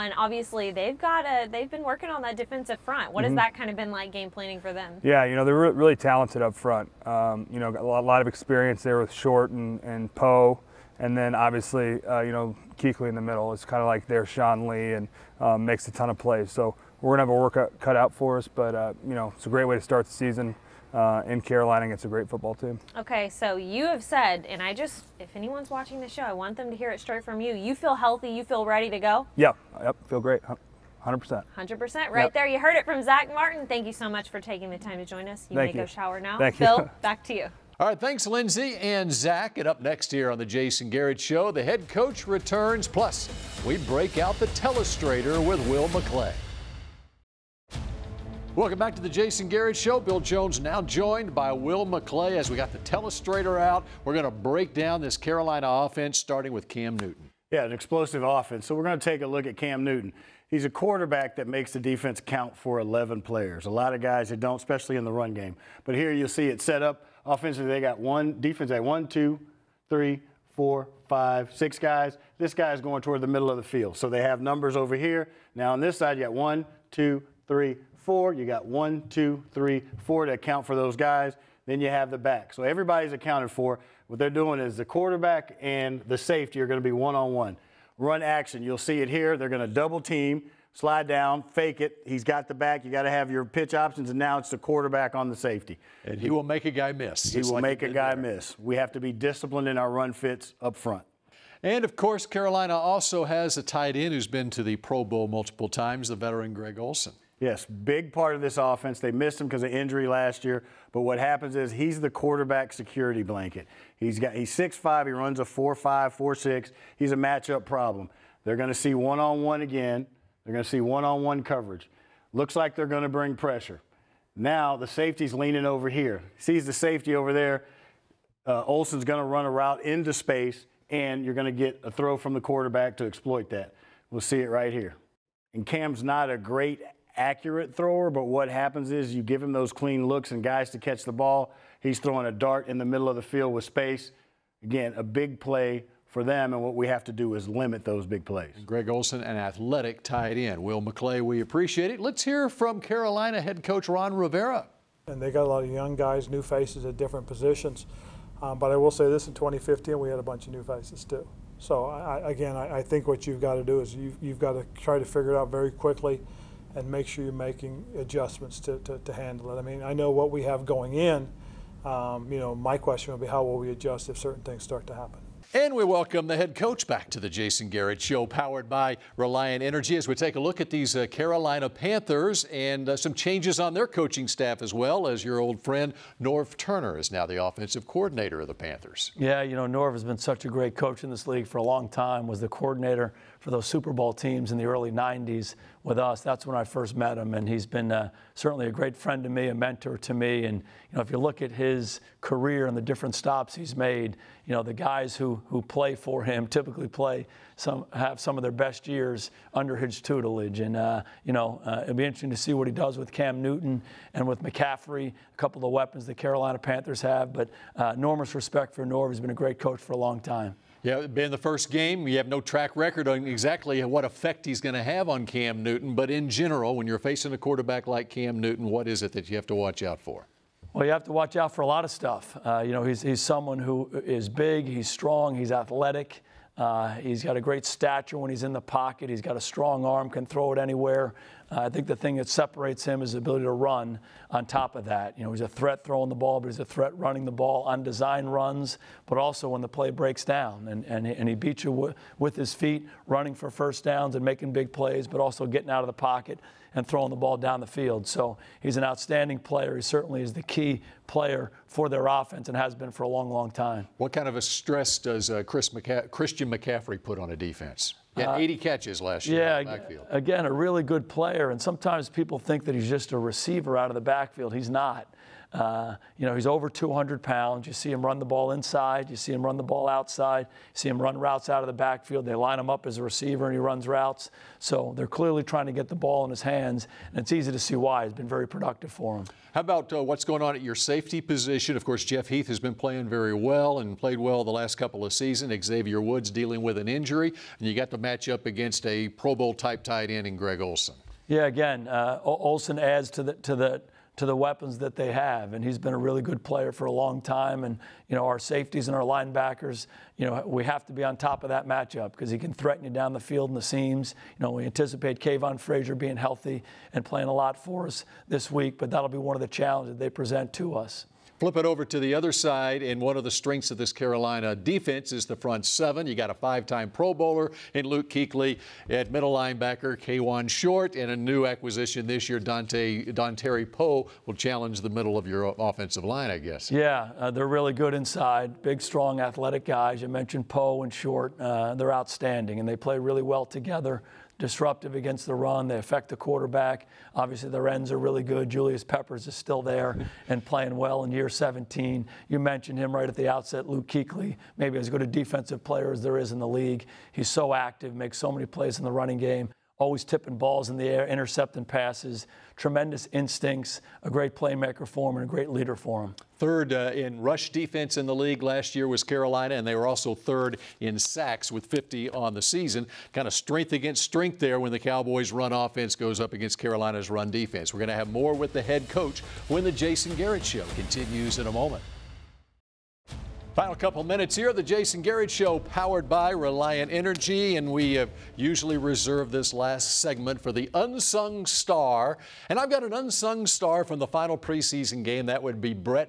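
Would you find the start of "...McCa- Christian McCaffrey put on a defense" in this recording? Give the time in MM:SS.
04:25.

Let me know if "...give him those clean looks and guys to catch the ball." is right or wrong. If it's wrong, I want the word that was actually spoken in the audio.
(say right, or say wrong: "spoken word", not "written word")
right.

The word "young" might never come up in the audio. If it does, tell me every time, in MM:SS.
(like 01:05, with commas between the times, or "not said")
02:35.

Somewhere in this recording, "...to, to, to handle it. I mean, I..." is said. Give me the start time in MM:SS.
02:48.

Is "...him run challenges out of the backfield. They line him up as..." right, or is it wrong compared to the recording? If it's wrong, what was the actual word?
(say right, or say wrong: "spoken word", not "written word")
wrong: "routes", not "challenges".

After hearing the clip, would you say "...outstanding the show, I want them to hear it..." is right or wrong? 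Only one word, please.
wrong.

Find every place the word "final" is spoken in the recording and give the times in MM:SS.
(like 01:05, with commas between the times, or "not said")
06:23, 06:34.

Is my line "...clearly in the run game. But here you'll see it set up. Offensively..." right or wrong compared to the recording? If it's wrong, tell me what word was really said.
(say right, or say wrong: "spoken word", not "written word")
wrong: "especially", not "clearly".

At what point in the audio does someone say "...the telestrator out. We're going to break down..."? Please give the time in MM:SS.
00:52.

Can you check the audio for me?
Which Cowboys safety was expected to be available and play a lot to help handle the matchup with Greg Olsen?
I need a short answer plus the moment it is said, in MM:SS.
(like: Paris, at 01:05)
Kavon Frazier, at 05:15.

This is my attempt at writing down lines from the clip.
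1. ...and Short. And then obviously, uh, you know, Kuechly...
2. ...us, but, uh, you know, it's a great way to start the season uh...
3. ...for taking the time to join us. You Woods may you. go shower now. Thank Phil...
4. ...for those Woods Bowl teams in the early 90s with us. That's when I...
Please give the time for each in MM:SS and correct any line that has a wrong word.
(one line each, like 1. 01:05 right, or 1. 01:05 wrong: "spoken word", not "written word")
1. 00:09 wrong: "Poe", not "Short"
2. 00:18 right
3. 00:34 wrong: "Thank", not "Woods"
4. 03:13 wrong: "Super", not "Woods".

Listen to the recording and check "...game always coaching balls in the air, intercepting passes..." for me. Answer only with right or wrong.
wrong.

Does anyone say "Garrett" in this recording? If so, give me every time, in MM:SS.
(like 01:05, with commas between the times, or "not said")
00:40, 00:49, 02:57, 06:20, 06:24.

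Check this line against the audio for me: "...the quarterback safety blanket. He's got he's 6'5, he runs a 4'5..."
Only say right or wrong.
wrong.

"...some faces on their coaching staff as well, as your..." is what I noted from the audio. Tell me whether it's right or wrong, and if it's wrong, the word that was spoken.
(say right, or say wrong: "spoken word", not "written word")
wrong: "changes", not "faces".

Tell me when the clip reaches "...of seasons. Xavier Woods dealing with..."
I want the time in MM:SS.
04:55.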